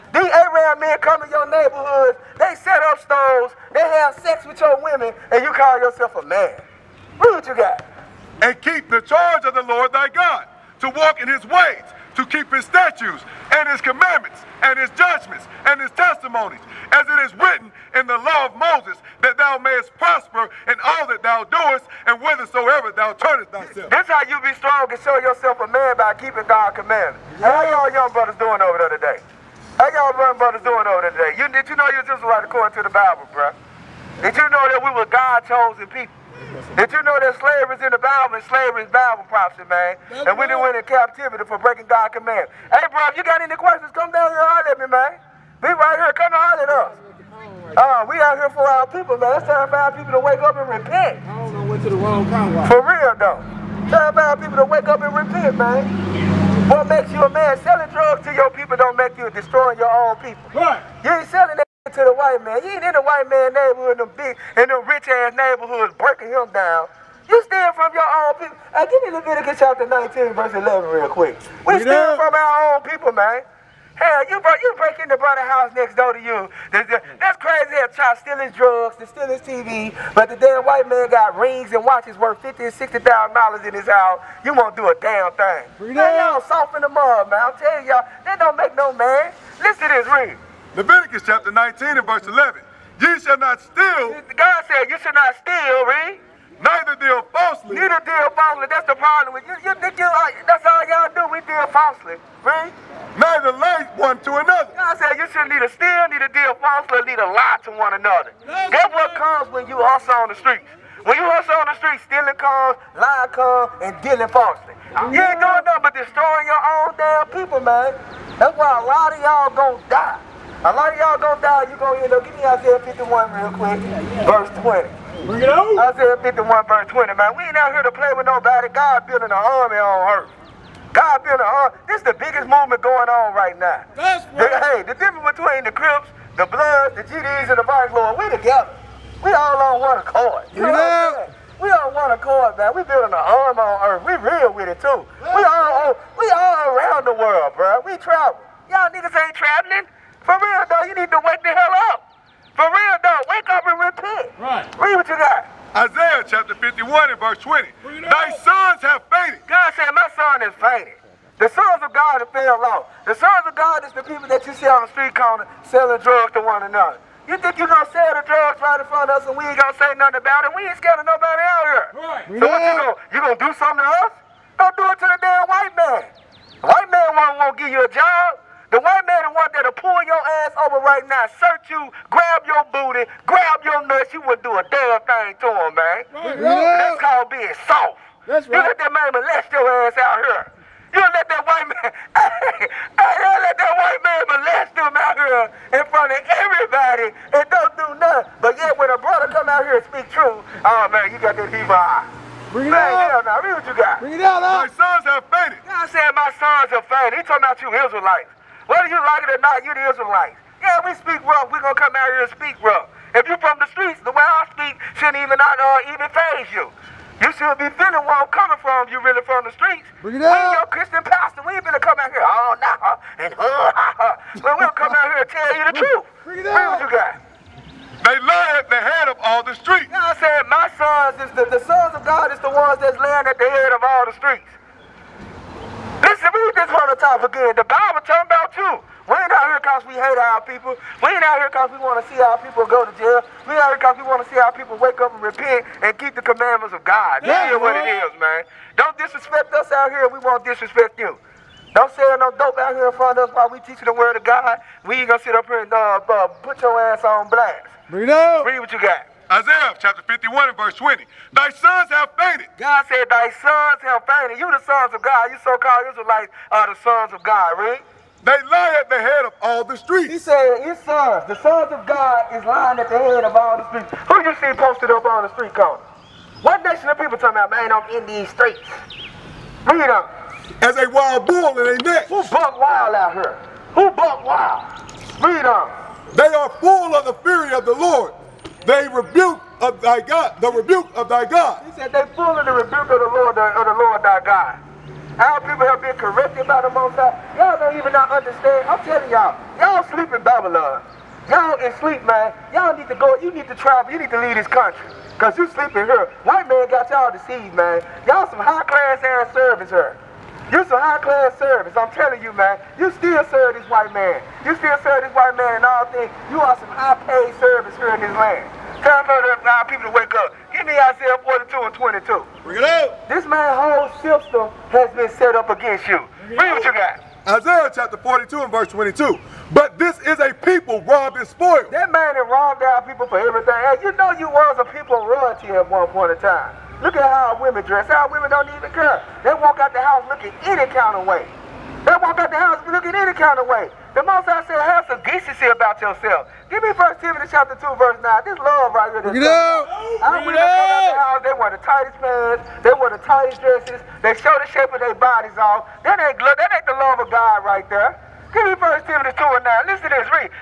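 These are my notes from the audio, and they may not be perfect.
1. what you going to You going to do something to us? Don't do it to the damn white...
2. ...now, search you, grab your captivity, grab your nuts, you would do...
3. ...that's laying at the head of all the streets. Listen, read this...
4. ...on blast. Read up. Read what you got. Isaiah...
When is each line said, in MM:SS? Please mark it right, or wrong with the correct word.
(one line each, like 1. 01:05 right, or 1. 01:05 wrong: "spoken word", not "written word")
1. 02:52 right
2. 03:01 wrong: "booty", not "captivity"
3. 03:52 right
4. 04:17 right.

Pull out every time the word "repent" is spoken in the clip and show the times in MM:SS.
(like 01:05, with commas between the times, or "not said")
00:50, 00:55, 02:33, 04:05.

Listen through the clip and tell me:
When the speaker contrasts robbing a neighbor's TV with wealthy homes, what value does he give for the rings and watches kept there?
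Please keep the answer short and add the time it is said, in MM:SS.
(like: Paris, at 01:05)
$50,000 to $60,000, at 01:22.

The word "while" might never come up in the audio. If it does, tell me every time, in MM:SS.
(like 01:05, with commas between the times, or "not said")
04:13.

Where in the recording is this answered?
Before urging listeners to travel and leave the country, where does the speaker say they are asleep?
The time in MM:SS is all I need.
05:00.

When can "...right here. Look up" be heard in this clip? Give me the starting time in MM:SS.
05:48.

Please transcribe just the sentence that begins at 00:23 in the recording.
That's how you be strong and show yourself a man by keeping God's commandments.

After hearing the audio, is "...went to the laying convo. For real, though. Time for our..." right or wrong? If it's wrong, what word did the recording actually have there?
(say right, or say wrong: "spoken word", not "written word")
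wrong: "wrong", not "laying".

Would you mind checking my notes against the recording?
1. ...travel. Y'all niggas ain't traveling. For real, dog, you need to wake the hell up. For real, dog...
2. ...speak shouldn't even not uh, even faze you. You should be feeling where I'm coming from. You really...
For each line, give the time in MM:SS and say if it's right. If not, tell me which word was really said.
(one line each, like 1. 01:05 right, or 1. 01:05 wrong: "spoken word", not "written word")
1. 02:27 right
2. 03:34 right.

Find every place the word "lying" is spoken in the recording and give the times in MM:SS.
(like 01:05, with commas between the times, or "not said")
01:52, 04:32.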